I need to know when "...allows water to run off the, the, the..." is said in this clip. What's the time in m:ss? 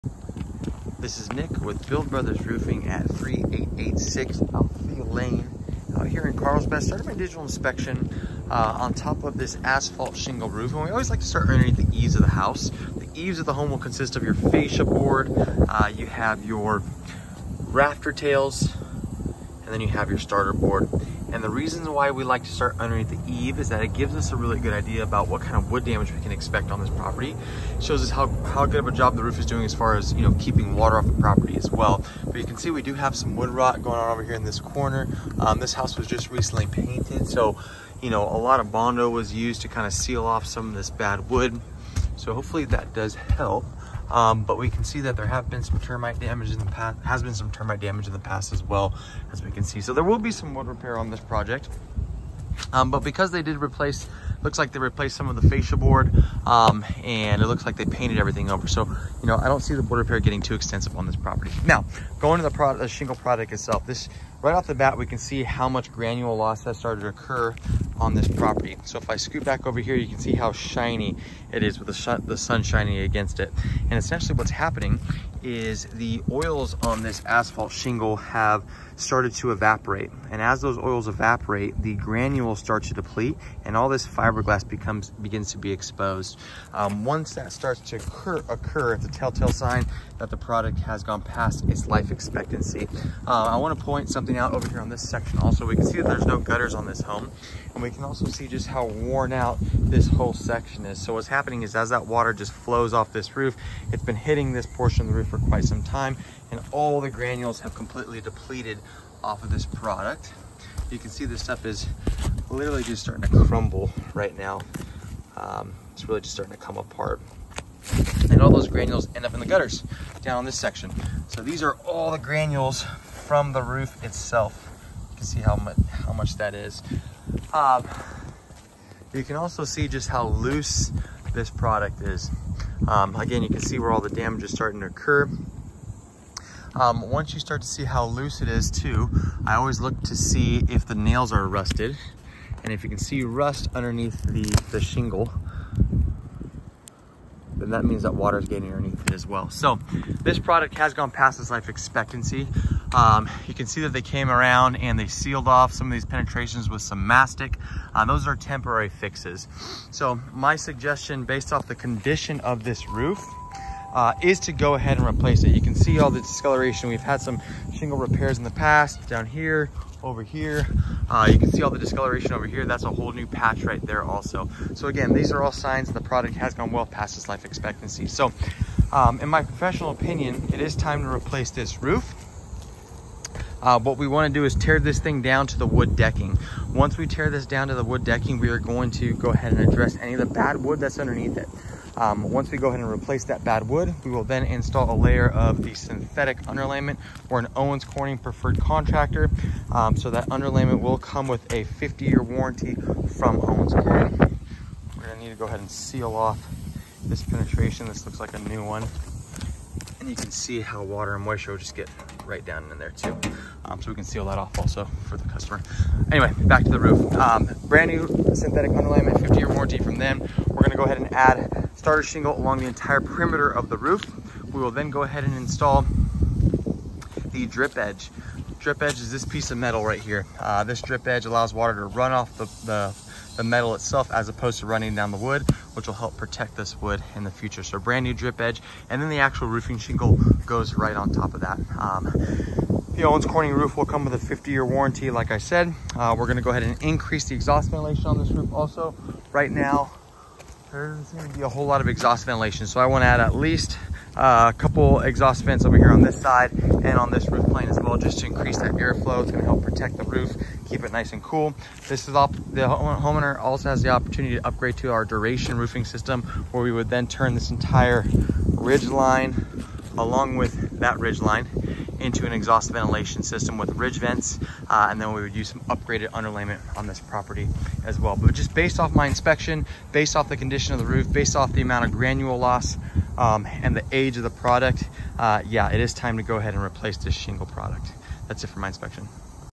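3:51.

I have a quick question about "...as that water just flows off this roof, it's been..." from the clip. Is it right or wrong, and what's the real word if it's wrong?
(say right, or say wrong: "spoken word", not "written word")
right.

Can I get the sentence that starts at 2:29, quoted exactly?
So this product has gone past its life expectancy.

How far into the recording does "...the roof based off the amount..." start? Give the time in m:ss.
4:40.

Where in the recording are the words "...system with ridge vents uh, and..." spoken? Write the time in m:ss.
4:33.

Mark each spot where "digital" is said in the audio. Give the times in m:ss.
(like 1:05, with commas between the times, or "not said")
0:07.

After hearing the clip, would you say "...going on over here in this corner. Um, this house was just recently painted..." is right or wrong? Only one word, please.
right.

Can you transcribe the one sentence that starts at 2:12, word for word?
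Um, again, you can see where all the damage is starting to occur.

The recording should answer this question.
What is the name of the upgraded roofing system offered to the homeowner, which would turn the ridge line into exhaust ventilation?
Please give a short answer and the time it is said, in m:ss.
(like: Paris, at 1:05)
Duration, at 4:25.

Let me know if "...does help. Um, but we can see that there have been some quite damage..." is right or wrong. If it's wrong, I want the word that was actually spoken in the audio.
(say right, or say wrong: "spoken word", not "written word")
wrong: "termite", not "quite".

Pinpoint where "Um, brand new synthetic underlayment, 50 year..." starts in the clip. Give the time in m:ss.
3:37.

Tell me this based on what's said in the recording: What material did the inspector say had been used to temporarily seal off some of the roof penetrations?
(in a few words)
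Mastic.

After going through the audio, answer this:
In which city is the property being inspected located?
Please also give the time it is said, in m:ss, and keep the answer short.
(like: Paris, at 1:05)
Carlsbad, at 0:06.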